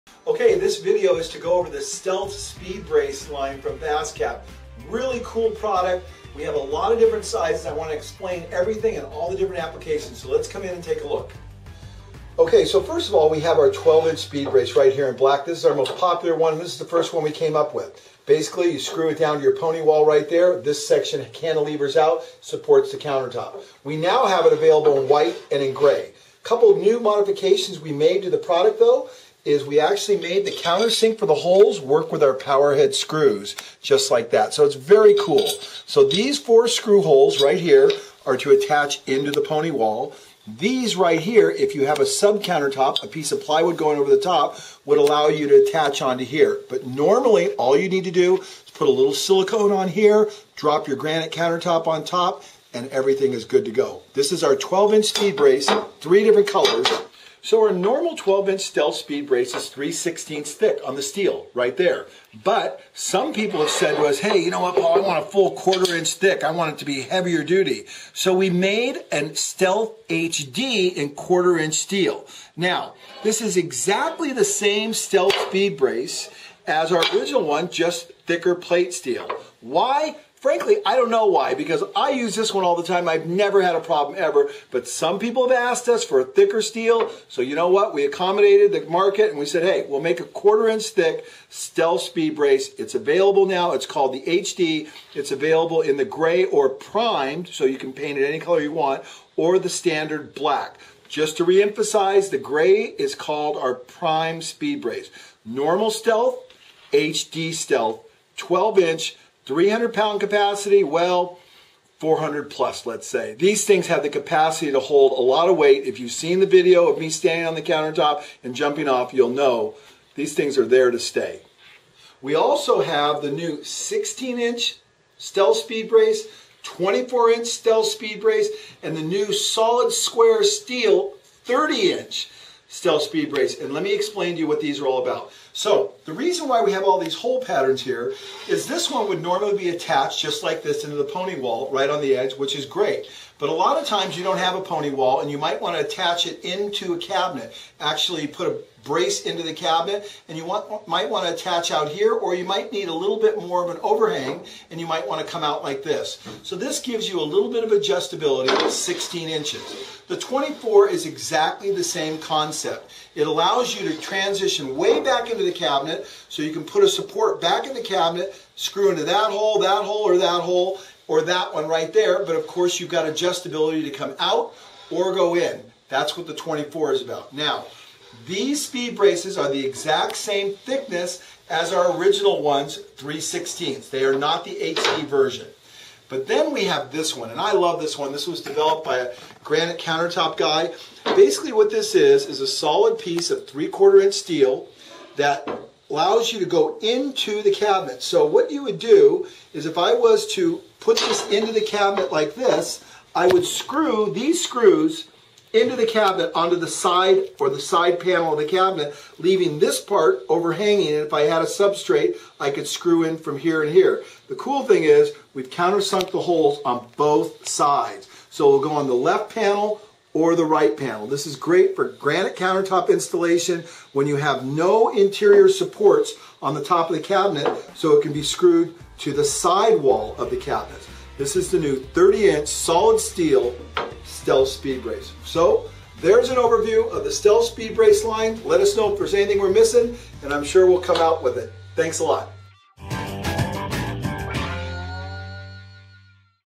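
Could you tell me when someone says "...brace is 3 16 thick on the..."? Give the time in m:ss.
0:59.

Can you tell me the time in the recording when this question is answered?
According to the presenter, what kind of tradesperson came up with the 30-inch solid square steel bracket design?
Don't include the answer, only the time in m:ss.
3:09.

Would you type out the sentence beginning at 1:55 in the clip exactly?
If you've seen the video of me standing on the countertop and jumping off, you'll know these things are there to stay.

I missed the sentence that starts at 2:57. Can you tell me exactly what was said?
Now, these speed braces are the exact same thickness as our original ones, 3 16 They are not the HD version.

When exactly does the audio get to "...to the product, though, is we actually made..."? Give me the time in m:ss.
0:28.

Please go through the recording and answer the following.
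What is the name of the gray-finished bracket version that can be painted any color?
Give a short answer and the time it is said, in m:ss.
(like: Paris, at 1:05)
prime speed brace, at 1:43.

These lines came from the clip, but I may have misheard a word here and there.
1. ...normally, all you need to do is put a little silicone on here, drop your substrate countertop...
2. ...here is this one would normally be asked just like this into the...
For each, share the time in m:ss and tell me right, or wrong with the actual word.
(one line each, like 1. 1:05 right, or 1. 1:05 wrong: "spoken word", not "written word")
1. 0:46 wrong: "granite", not "substrate"
2. 2:17 wrong: "attached", not "asked".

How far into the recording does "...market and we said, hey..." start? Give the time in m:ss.
1:28.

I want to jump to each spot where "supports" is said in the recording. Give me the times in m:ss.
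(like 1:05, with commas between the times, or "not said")
0:22, 2:46, 3:45.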